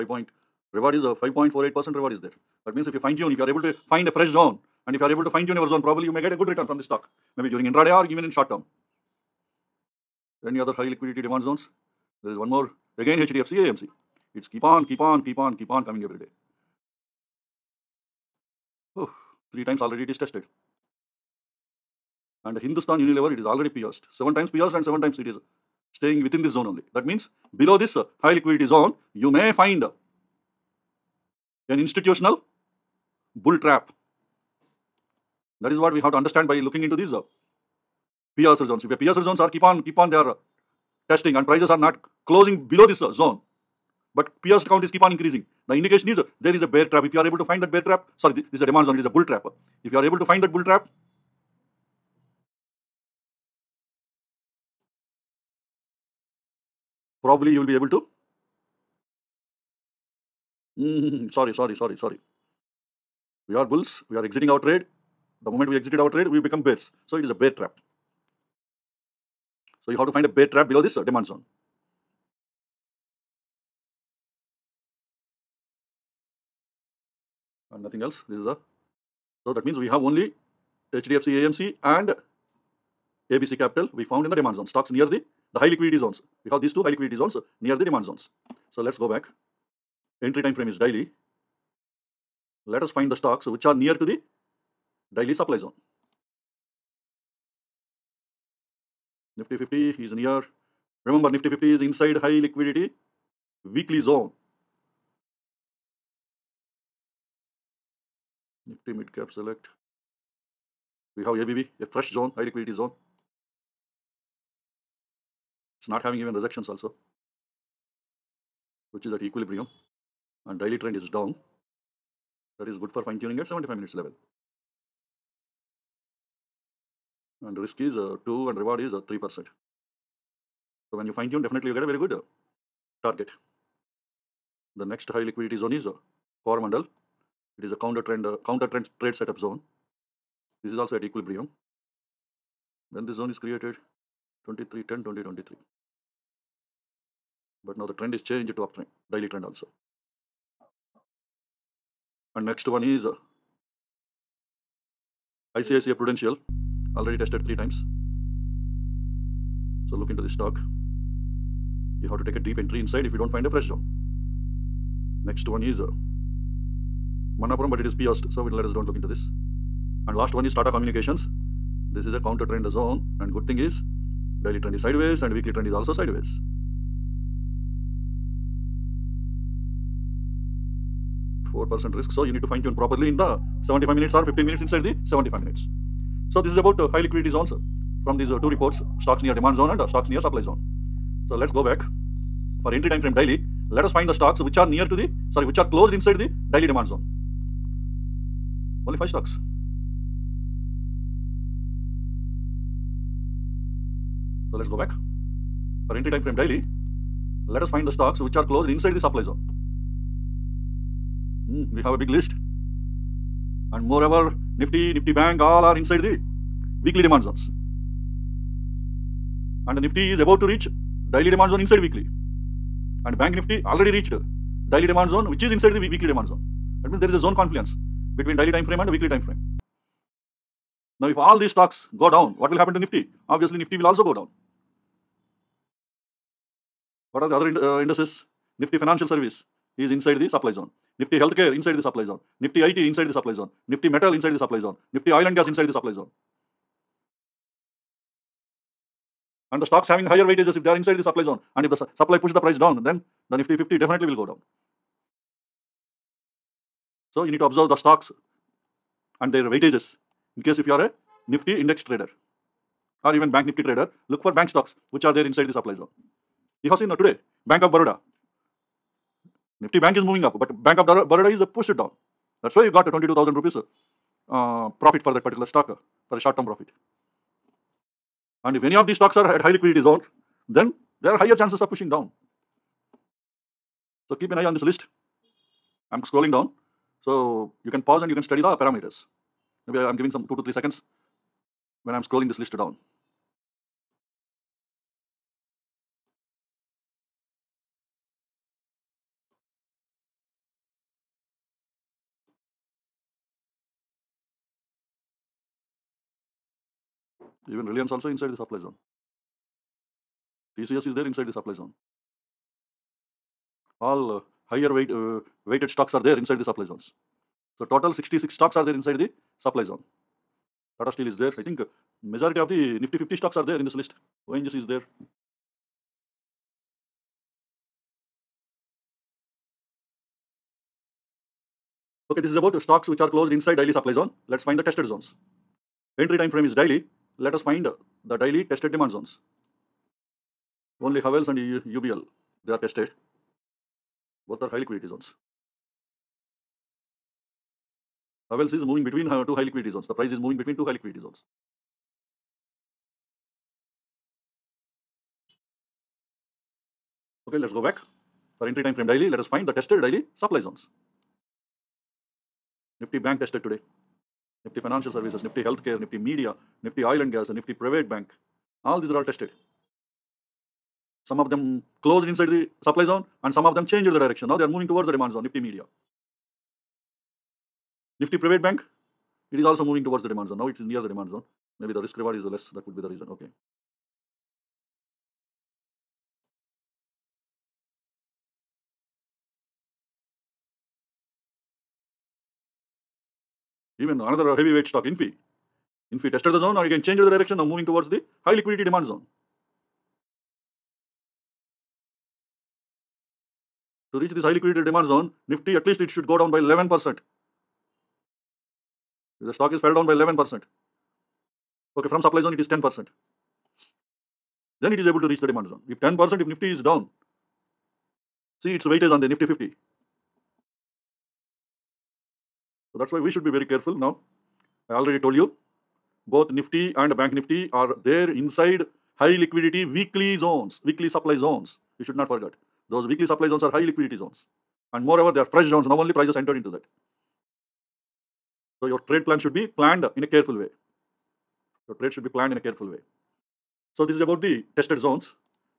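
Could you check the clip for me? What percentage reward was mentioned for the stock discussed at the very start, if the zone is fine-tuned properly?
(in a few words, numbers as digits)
5.48%.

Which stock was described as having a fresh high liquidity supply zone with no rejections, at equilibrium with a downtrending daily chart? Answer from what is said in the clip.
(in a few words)
ABB.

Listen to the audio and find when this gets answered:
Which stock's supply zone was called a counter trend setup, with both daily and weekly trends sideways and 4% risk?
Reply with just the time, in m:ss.
2:50.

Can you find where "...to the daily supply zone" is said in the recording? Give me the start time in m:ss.
1:34.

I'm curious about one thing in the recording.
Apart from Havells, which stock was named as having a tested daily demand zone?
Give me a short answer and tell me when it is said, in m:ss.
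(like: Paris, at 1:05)
UBL, at 5:41.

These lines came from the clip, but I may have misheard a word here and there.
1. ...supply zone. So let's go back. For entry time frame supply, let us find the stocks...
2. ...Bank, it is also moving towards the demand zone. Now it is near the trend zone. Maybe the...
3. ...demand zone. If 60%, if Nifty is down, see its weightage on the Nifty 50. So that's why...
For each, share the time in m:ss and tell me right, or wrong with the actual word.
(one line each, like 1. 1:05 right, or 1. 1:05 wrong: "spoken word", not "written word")
1. 3:10 wrong: "daily", not "supply"
2. 6:18 wrong: "demand", not "trend"
3. 6:55 wrong: "10", not "60".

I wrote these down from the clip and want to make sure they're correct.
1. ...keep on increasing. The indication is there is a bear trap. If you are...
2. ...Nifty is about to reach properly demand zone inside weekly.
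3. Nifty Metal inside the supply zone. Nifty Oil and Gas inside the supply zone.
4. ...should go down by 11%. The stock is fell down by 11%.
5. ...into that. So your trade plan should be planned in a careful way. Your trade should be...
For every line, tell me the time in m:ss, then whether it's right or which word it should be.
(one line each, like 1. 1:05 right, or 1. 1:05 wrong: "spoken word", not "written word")
1. 0:44 right
2. 3:39 wrong: "daily", not "properly"
3. 4:03 right
4. 6:45 right
5. 7:16 right.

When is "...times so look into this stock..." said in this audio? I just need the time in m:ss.
2:37.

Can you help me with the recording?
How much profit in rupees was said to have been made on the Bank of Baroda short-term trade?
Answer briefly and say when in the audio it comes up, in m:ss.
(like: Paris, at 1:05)
22,000 rupees, at 4:32.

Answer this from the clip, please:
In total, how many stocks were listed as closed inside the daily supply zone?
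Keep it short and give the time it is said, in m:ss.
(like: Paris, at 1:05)
66, at 5:17.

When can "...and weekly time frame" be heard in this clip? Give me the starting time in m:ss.
3:48.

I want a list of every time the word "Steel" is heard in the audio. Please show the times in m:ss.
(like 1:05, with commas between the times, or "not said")
5:20.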